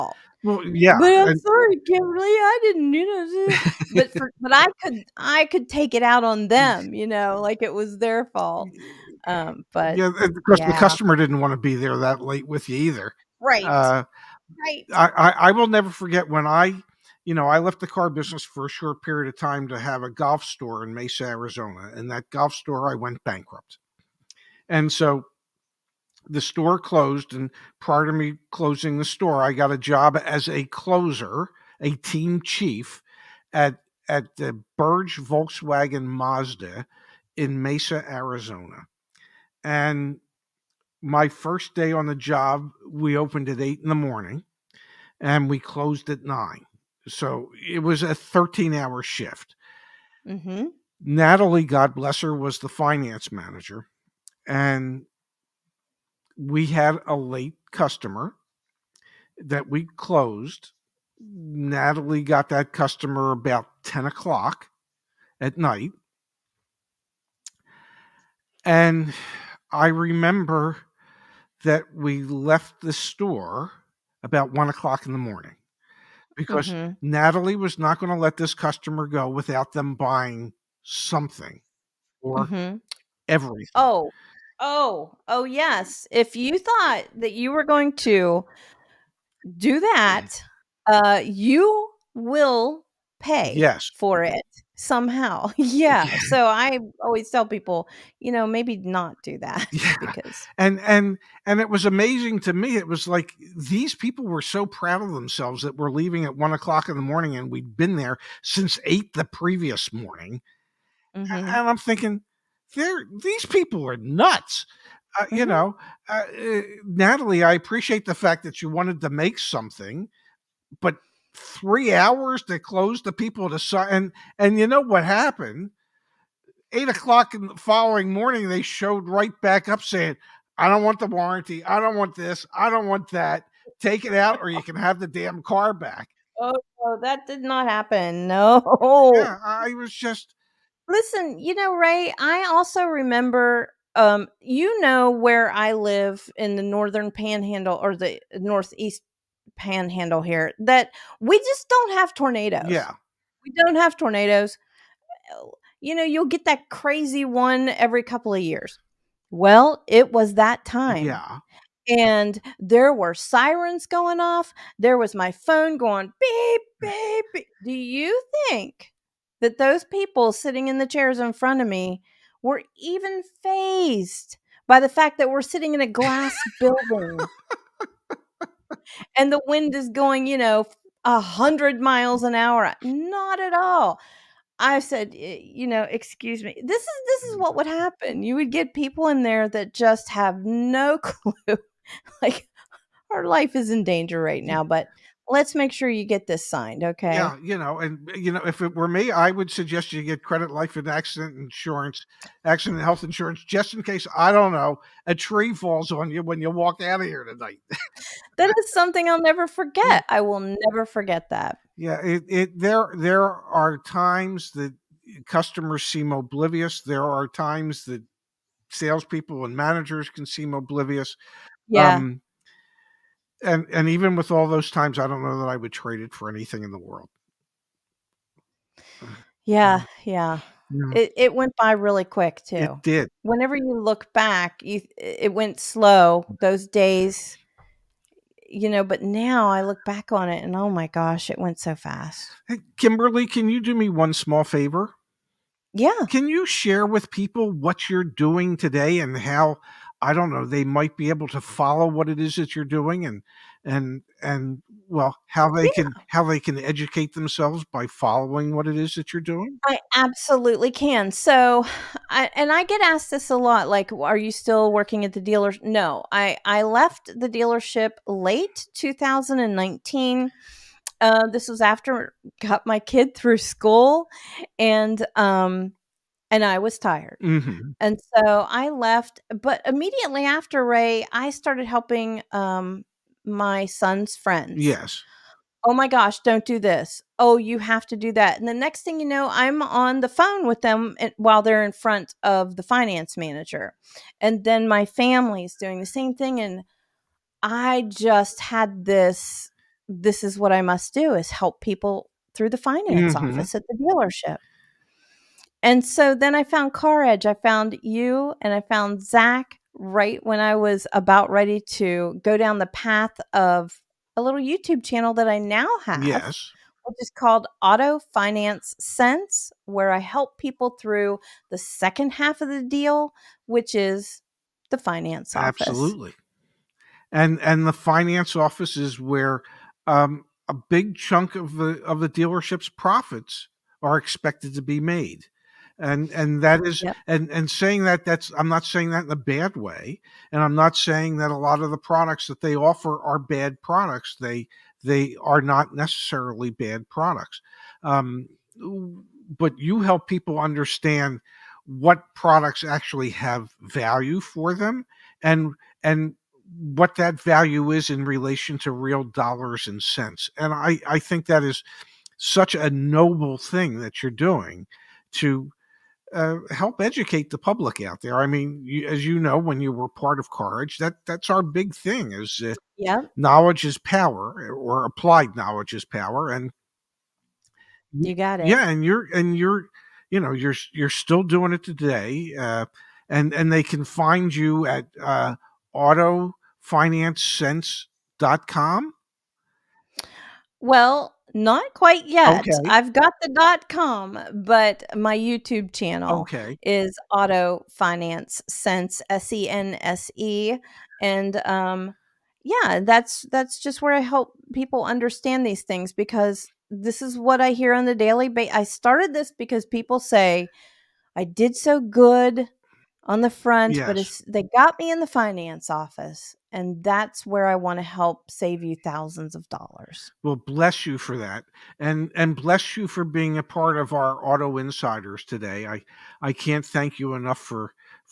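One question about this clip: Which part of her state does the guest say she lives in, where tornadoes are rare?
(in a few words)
northeast panhandle.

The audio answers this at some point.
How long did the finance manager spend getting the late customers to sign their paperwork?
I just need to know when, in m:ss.
2:01.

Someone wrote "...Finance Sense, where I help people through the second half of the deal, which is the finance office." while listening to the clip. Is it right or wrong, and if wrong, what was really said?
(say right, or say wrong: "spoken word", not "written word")
right.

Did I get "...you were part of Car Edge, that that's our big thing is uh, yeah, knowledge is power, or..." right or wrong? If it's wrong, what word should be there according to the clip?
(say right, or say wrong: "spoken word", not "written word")
right.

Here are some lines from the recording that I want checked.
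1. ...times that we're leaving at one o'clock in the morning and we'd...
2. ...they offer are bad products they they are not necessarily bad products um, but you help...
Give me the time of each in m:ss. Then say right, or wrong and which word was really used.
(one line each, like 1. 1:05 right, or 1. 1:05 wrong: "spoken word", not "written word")
1. 1:45 wrong: "themselves", not "times"
2. 5:42 right.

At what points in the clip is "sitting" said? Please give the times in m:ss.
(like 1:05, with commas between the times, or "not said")
2:50, 2:55.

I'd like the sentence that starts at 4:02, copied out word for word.
Hey, Kimberly, can you do me one small favor?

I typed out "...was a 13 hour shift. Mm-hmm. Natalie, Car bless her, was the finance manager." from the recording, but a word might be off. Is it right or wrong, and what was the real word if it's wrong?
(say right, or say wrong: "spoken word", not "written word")
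wrong: "God", not "Car".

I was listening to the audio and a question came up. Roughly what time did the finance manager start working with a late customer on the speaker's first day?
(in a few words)
10 o'clock at night.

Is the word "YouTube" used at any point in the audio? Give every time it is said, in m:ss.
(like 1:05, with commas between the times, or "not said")
5:14, 6:35.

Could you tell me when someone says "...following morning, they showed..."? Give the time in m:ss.
2:07.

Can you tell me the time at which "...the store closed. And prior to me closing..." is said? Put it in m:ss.
0:26.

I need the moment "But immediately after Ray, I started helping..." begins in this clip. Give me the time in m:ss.
4:39.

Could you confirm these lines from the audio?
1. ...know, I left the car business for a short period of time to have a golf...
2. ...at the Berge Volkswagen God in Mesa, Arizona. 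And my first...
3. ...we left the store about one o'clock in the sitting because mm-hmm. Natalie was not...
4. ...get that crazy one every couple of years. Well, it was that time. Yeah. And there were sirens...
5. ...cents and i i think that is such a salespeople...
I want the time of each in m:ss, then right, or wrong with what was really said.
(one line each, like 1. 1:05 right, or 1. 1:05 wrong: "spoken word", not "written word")
1. 0:17 right
2. 0:34 wrong: "Mazda", not "God"
3. 1:11 wrong: "morning", not "sitting"
4. 2:36 right
5. 5:59 wrong: "noble", not "salespeople".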